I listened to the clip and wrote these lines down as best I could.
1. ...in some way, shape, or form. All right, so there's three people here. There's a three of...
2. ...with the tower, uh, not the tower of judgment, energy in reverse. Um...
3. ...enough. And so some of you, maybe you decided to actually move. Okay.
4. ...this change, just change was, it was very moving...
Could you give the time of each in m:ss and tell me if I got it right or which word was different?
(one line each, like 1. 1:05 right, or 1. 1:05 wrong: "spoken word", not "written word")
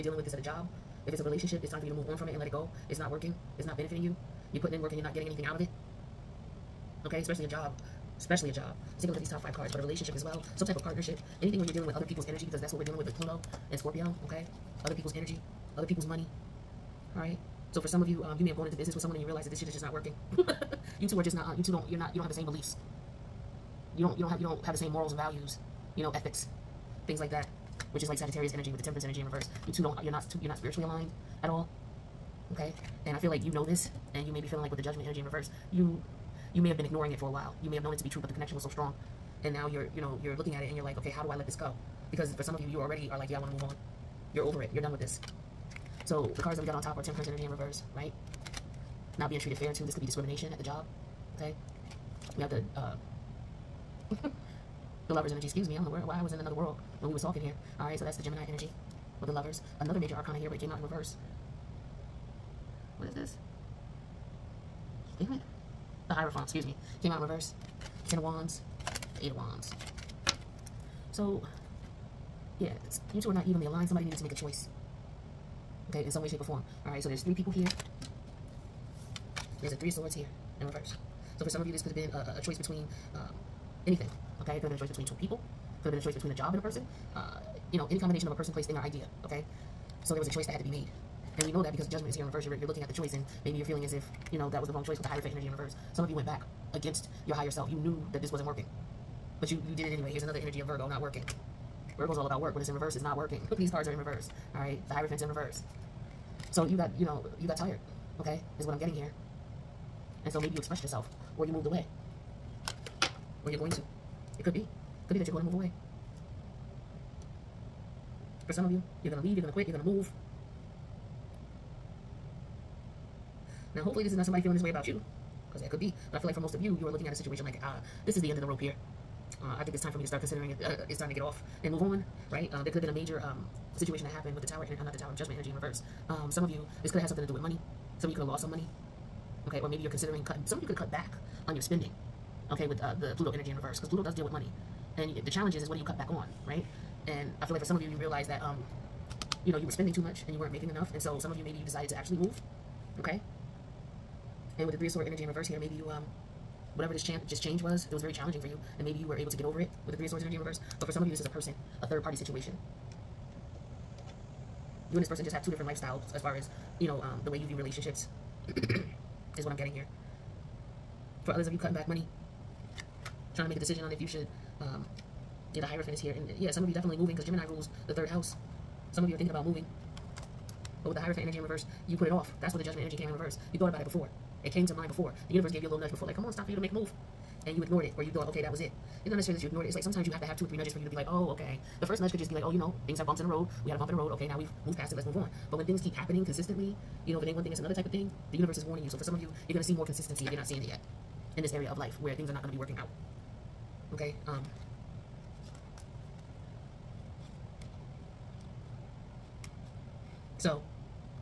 1. 1:16 right
2. 2:14 right
3. 2:30 right
4. 2:36 wrong: "challenging", not "moving".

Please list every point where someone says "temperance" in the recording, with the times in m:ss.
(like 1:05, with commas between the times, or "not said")
0:28, 0:47.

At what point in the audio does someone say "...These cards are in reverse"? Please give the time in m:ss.
1:43.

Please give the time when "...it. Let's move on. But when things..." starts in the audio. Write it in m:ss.
3:14.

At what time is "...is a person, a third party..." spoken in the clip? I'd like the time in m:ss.
2:41.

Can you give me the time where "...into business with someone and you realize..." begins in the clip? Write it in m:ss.
0:18.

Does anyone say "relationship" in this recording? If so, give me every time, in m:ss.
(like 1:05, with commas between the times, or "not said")
0:01, 0:09, 2:47.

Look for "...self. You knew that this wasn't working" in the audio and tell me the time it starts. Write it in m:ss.
1:37.